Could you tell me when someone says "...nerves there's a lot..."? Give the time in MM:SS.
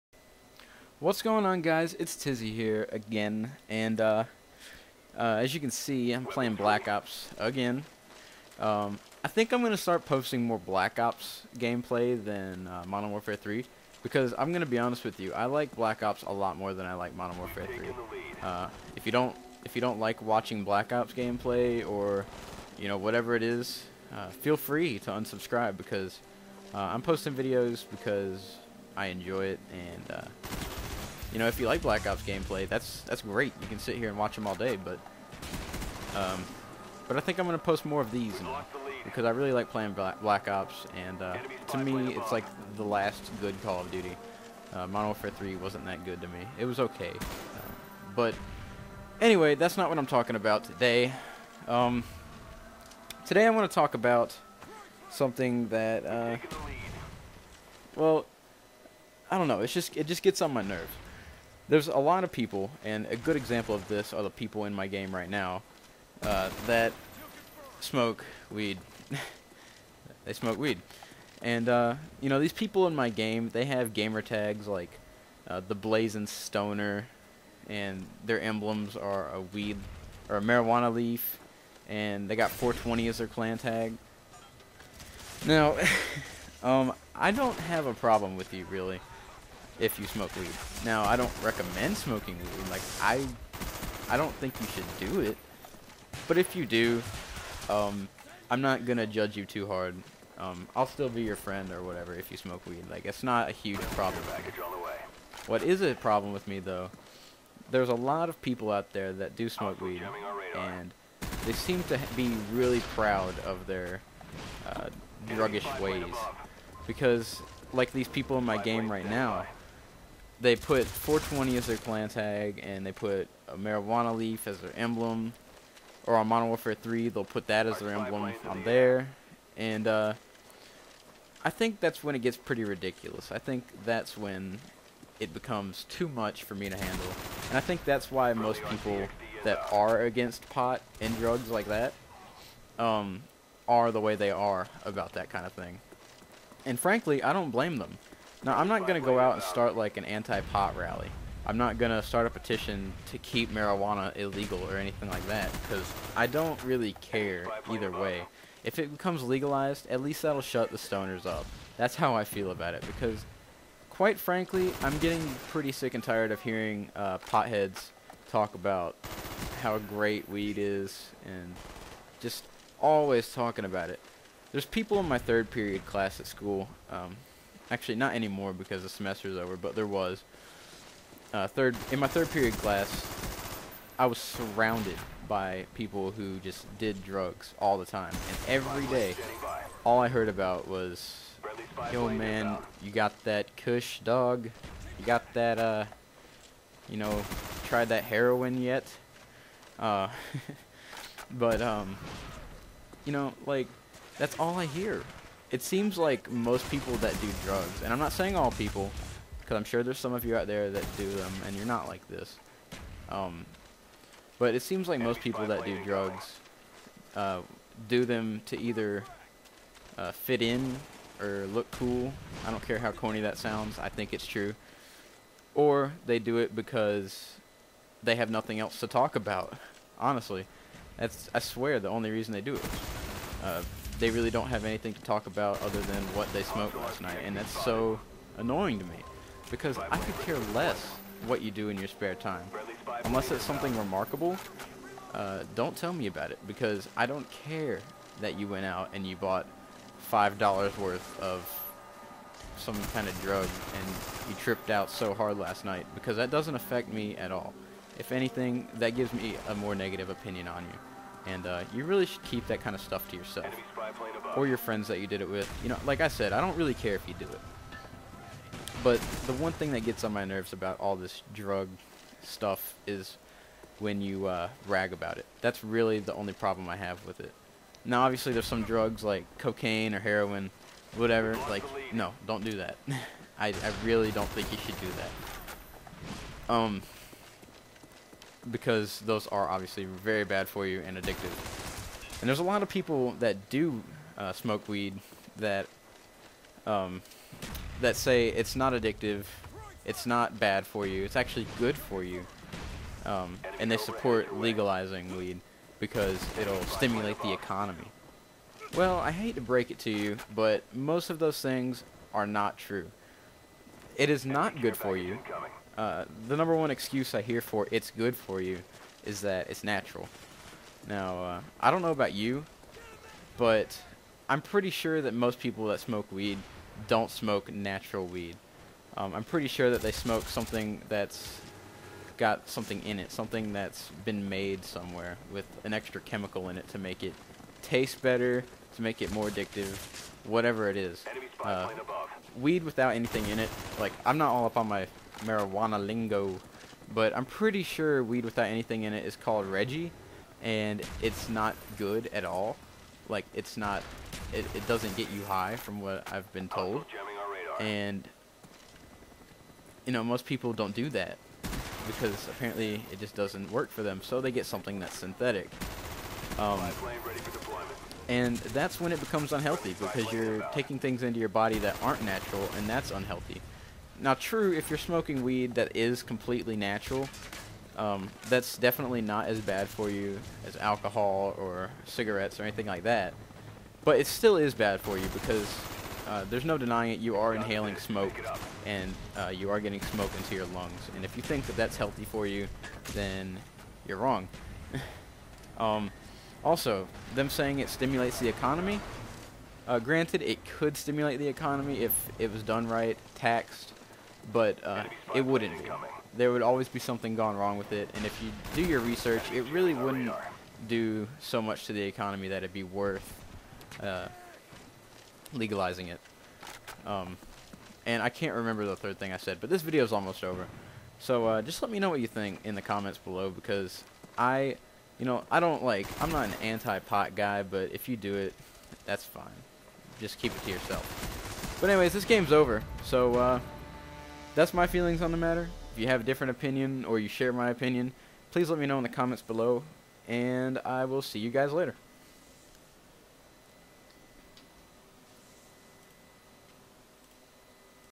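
01:00.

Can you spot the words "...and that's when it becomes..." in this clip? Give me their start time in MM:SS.
06:08.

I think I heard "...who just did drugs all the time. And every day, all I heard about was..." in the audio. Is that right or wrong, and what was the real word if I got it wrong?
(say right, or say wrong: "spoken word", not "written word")
right.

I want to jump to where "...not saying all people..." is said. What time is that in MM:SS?
03:27.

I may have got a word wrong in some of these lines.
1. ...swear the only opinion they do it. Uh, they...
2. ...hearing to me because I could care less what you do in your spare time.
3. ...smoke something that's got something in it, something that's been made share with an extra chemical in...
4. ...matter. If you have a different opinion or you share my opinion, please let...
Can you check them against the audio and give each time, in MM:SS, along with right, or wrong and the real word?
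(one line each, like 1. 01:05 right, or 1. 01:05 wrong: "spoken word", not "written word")
1. 03:51 wrong: "reason", not "opinion"
2. 03:58 wrong: "annoying", not "hearing"
3. 05:29 wrong: "somewhere", not "share"
4. 07:15 right.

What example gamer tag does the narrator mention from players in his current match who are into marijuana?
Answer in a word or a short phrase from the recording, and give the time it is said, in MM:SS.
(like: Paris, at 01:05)
the Blazing Stoner, at 01:15.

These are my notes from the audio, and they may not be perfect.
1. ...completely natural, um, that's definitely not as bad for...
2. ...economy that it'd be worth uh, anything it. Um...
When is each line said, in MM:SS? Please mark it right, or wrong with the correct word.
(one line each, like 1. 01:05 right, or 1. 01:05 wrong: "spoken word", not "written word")
1. 06:16 right
2. 06:51 wrong: "legalizing", not "anything".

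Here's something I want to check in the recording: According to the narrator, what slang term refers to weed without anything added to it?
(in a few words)
Reggie.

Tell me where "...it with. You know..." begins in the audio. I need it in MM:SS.
04:25.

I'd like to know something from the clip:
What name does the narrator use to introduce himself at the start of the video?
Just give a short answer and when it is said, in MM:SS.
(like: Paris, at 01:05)
Tizzy, at 00:02.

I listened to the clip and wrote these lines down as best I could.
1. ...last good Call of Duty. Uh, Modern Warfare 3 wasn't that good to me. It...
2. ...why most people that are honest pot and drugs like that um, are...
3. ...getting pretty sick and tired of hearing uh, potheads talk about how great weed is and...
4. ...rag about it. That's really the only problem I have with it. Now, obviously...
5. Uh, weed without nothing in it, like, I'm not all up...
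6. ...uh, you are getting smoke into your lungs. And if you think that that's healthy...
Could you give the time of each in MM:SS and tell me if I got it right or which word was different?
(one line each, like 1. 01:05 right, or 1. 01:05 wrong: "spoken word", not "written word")
1. 00:42 right
2. 02:18 wrong: "against", not "honest"
3. 02:44 right
4. 04:34 right
5. 05:41 wrong: "anything", not "nothing"
6. 06:29 right.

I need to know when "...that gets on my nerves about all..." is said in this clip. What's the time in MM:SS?
04:29.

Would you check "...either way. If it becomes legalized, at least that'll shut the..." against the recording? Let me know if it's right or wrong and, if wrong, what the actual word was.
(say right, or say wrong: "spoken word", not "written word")
right.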